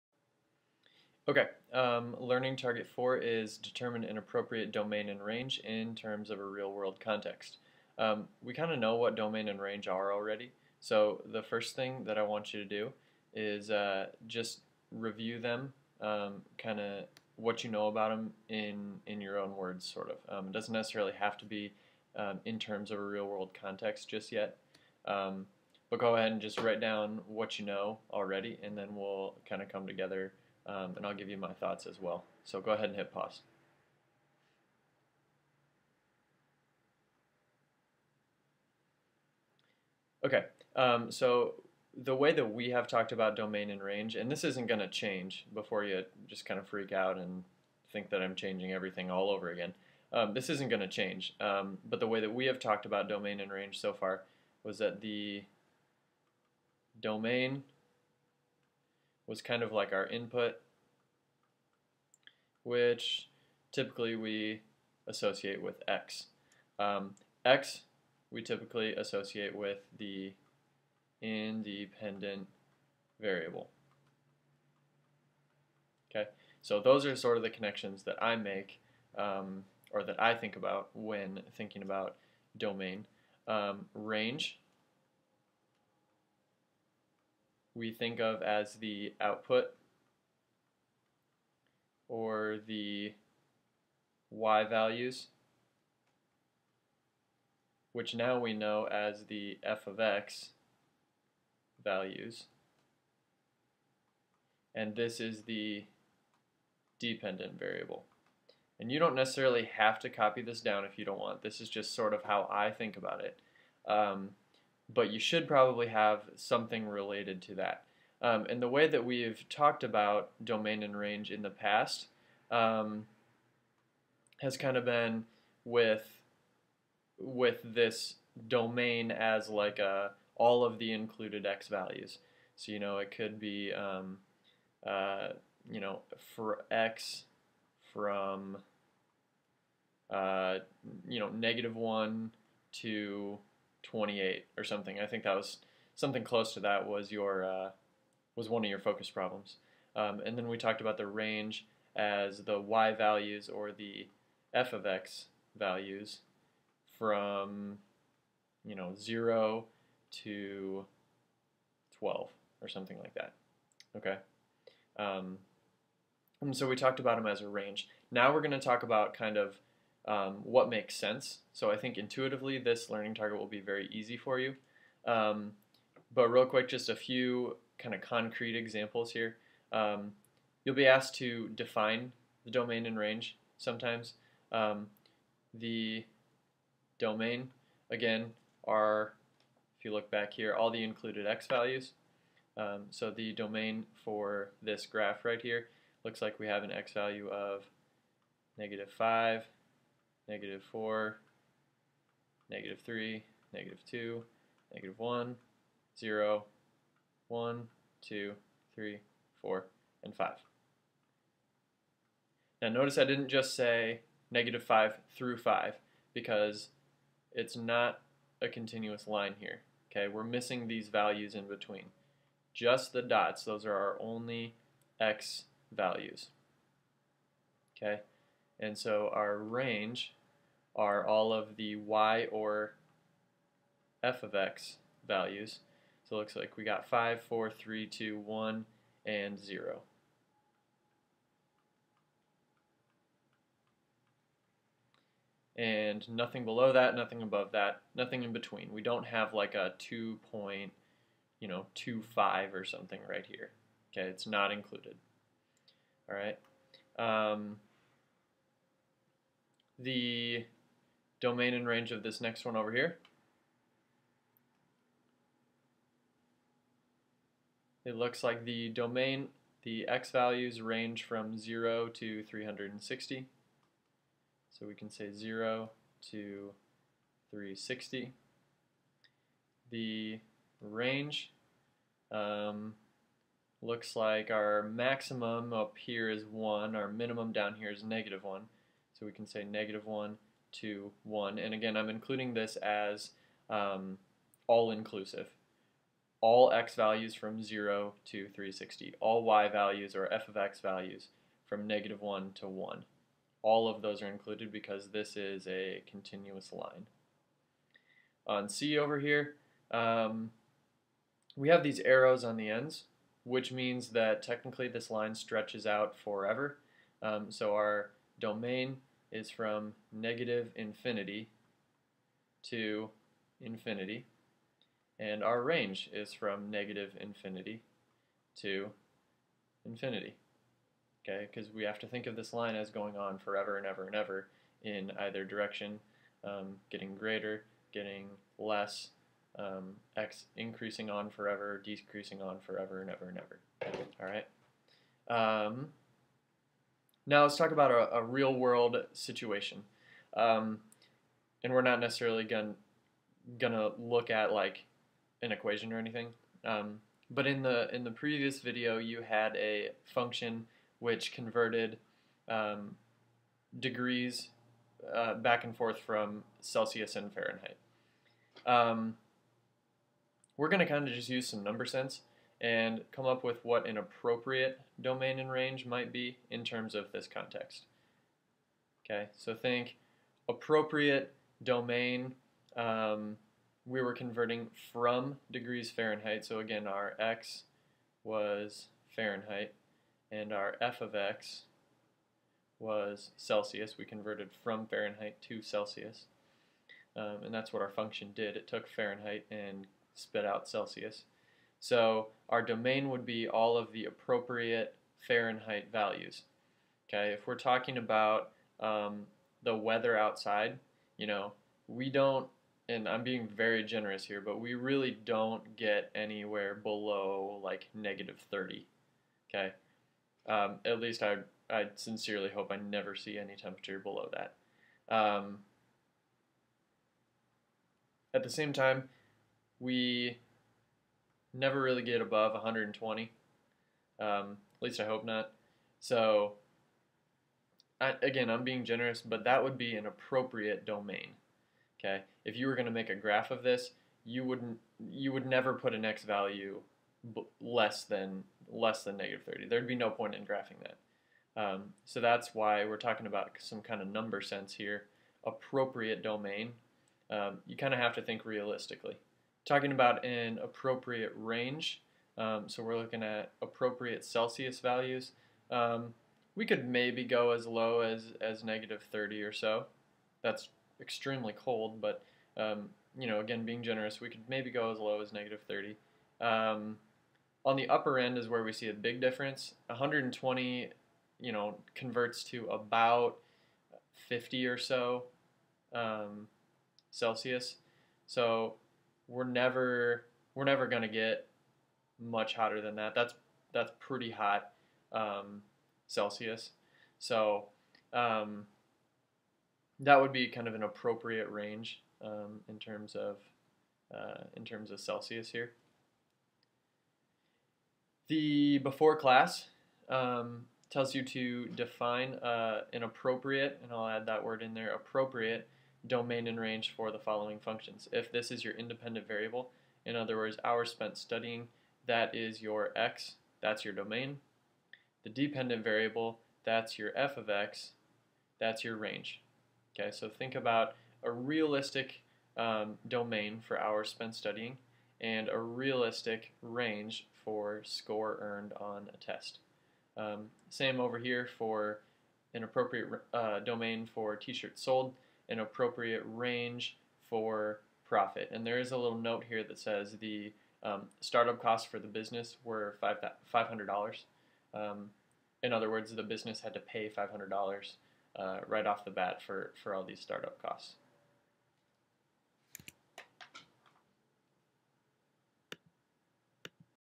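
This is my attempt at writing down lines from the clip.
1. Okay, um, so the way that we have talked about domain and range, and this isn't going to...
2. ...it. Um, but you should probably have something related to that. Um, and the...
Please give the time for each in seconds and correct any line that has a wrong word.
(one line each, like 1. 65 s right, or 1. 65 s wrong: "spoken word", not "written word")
1. 40 s right
2. 113 s right.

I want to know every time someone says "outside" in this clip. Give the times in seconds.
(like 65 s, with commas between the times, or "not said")
409 s.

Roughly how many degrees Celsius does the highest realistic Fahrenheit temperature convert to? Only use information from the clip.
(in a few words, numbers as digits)
50.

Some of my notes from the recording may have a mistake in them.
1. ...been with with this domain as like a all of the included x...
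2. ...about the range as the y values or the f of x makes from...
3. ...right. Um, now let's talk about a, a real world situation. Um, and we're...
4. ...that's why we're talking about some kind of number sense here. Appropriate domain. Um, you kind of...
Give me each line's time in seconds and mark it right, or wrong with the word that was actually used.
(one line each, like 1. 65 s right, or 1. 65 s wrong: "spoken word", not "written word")
1. 124 s right
2. 150 s wrong: "values", not "makes"
3. 344 s right
4. 452 s right.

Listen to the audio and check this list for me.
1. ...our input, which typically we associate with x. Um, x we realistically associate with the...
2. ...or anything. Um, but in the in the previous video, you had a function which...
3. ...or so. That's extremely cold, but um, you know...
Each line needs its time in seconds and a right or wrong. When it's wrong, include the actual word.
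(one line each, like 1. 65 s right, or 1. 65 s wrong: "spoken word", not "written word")
1. 59 s wrong: "typically", not "realistically"
2. 355 s right
3. 469 s right.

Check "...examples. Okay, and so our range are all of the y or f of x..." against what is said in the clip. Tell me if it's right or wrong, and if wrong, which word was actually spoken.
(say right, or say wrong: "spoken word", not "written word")
wrong: "values", not "examples".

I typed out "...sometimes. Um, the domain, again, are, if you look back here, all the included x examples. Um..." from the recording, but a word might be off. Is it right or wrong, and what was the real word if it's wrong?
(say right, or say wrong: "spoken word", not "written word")
wrong: "values", not "examples".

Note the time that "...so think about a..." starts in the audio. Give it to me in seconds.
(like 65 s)
529 s.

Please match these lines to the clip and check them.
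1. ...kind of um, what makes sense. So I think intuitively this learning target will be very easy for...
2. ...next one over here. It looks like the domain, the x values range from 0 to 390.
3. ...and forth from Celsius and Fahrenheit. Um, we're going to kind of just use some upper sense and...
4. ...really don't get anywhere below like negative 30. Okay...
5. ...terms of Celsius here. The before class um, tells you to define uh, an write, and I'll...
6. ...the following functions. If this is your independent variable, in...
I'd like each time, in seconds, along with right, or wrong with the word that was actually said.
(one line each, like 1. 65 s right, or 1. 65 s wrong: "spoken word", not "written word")
1. 169 s right
2. 262 s wrong: "360", not "390"
3. 365 s wrong: "number", not "upper"
4. 414 s right
5. 504 s wrong: "appropriate", not "write"
6. 516 s right.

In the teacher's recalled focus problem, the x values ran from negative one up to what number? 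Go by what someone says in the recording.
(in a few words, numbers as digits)
28.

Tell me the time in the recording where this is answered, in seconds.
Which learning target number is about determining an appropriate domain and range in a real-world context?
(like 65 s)
2 s.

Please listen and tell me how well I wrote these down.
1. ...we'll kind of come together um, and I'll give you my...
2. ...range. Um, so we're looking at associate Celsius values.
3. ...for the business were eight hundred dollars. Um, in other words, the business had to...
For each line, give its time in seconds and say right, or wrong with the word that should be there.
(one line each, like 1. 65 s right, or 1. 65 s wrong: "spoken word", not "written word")
1. 28 s right
2. 461 s wrong: "appropriate", not "associate"
3. 551 s wrong: "five", not "eight".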